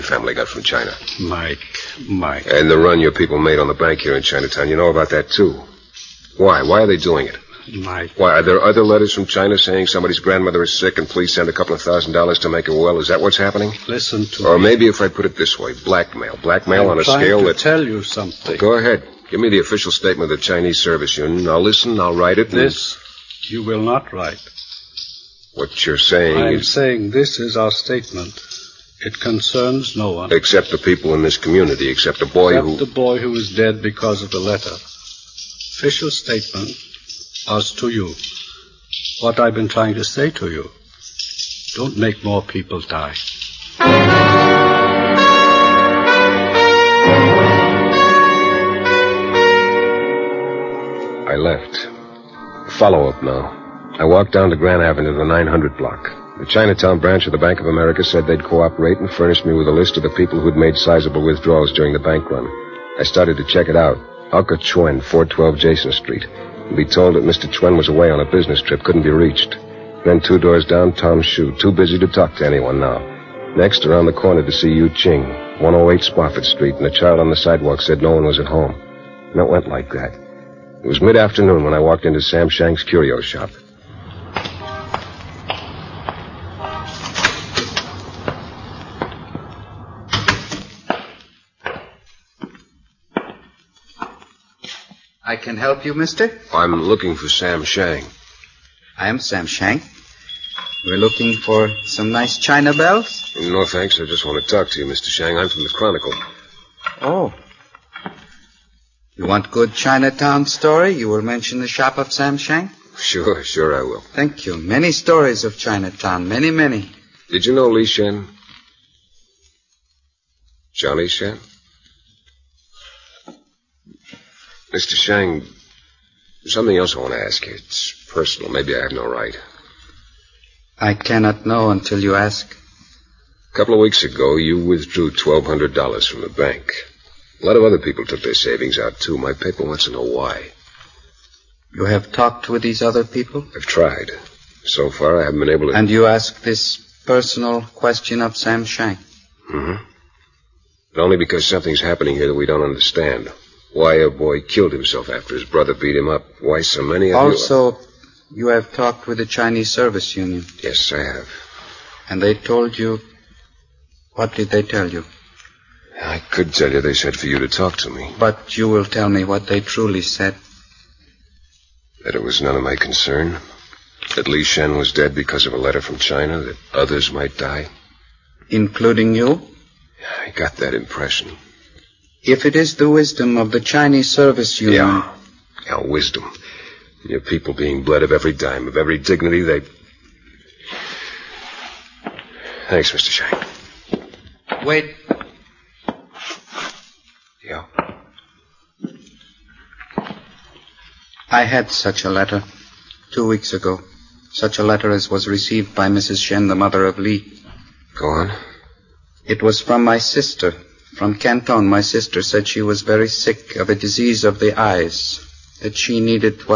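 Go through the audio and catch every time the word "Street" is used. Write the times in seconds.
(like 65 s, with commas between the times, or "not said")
65 s, 76 s.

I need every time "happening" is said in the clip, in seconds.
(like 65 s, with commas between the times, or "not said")
13 s, 151 s.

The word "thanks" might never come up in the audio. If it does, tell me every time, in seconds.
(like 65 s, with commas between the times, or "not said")
103 s, 114 s, 192 s.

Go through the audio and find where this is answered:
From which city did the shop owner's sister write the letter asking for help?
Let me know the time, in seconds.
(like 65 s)
211 s.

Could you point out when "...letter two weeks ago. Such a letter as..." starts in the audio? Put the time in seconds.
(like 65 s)
202 s.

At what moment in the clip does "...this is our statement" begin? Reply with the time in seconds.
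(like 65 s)
27 s.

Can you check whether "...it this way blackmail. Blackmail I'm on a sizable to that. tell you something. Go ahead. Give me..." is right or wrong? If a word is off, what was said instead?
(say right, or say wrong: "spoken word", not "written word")
wrong: "scale", not "sizable".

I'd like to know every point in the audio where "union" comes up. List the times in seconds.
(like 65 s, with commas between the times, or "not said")
21 s, 160 s, 184 s.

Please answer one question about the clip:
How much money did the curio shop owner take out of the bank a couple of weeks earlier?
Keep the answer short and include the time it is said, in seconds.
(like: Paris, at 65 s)
$1,200, at 135 s.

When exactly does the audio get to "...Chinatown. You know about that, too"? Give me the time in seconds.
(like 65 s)
4 s.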